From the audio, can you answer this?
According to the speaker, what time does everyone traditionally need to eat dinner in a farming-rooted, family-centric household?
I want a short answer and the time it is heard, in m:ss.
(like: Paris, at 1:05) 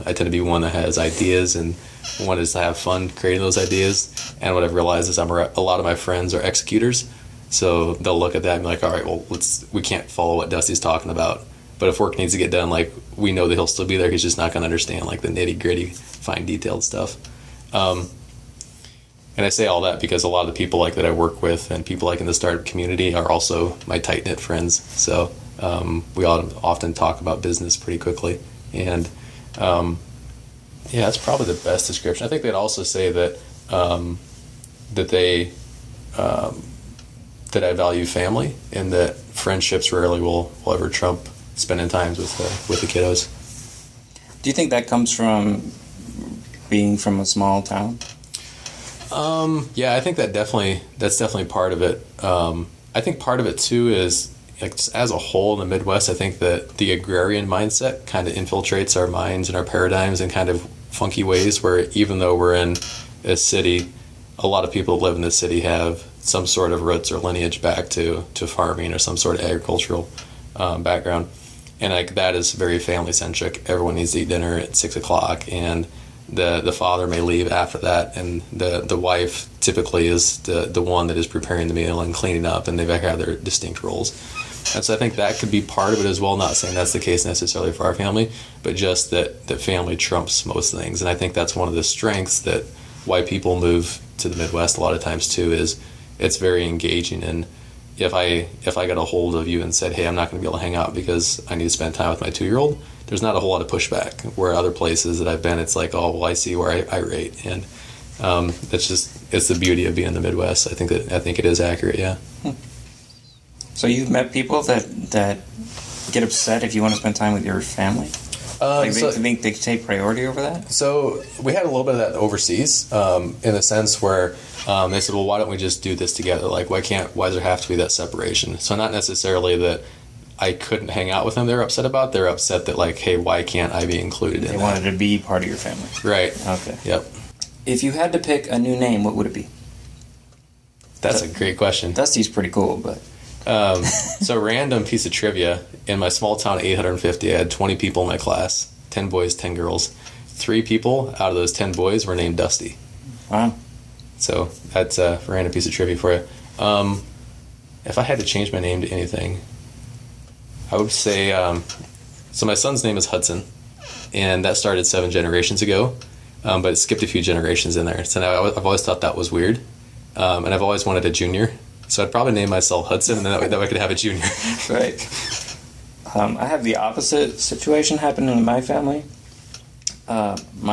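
6 o'clock, at 1:14.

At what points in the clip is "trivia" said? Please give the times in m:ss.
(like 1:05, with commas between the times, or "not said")
2:25, 2:35.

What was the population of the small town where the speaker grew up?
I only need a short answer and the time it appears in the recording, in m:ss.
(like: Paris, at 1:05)
850, at 2:26.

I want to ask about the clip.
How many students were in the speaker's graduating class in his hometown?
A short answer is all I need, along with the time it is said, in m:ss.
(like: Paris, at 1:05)
20, at 2:27.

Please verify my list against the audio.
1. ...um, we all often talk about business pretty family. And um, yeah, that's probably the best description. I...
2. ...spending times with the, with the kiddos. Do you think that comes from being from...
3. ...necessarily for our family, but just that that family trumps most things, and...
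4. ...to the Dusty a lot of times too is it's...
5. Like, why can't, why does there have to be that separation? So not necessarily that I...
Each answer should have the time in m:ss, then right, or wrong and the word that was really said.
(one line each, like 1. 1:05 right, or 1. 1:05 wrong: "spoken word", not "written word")
1. 0:25 wrong: "quickly", not "family"
2. 0:41 right
3. 1:27 right
4. 1:34 wrong: "Midwest", not "Dusty"
5. 2:06 right.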